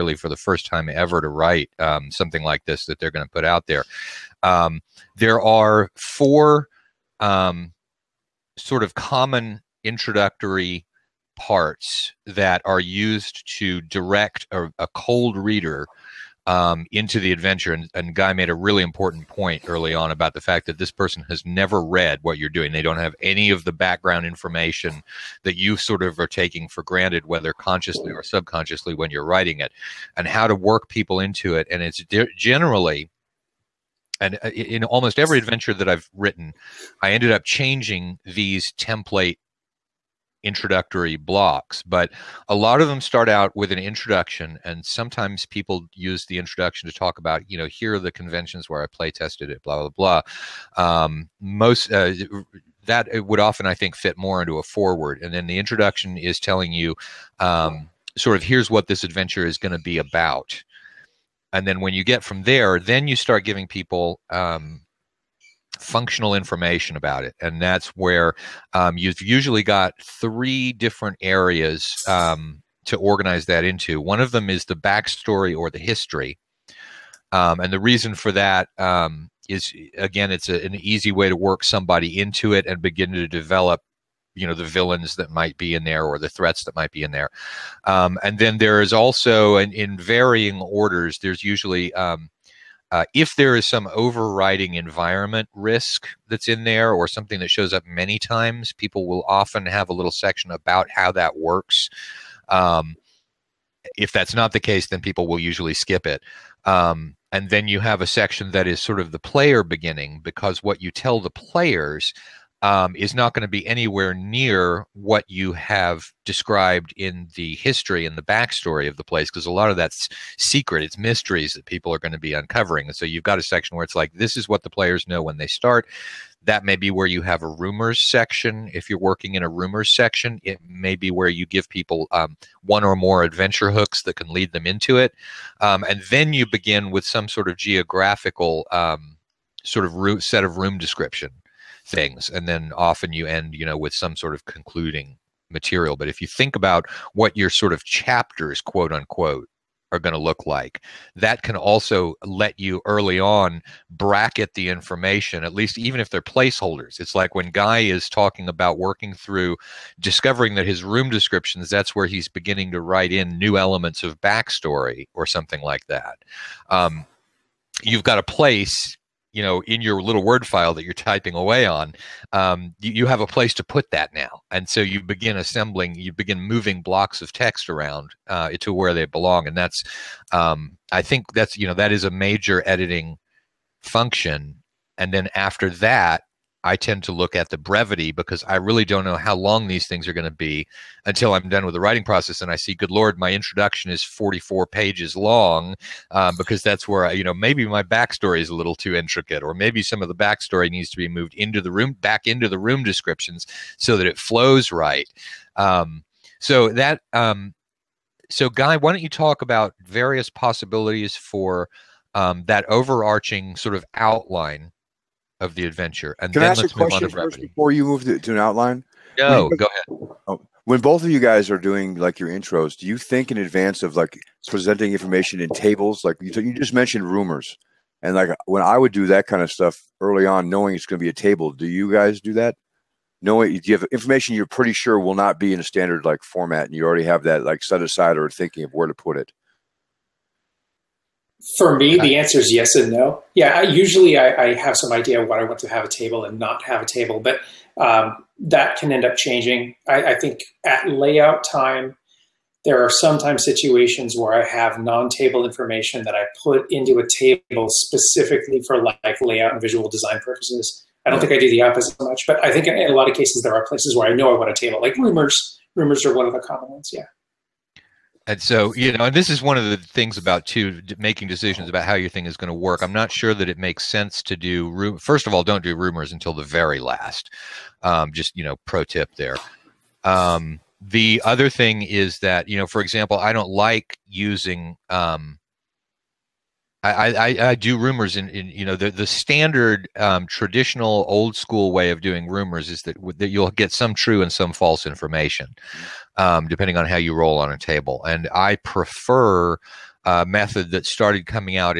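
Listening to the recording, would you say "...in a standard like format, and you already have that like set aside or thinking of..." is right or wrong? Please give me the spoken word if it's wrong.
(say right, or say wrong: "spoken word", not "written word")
right.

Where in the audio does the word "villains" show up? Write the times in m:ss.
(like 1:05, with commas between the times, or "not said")
1:24.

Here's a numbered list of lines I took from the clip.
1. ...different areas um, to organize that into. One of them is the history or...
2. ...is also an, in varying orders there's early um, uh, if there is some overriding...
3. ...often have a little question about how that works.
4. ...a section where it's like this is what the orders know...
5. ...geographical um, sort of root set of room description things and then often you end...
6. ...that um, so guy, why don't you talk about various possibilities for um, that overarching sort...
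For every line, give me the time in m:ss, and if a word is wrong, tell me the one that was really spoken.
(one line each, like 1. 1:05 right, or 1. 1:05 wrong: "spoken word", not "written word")
1. 1:10 wrong: "backstory", not "history"
2. 1:28 wrong: "usually", not "early"
3. 1:39 wrong: "section", not "question"
4. 2:03 wrong: "players", not "orders"
5. 2:17 right
6. 3:26 right.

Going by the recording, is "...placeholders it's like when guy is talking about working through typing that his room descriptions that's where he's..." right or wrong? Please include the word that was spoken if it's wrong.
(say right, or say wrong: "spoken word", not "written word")
wrong: "discovering", not "typing".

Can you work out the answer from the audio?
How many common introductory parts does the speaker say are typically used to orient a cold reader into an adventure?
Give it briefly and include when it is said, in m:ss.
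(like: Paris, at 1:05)
4, at 0:05.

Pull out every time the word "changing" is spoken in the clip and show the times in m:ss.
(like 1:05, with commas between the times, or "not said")
0:37, 4:09.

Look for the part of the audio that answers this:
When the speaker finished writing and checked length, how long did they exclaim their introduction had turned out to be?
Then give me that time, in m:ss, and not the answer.
3:14.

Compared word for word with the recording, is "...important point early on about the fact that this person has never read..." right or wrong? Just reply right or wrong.
right.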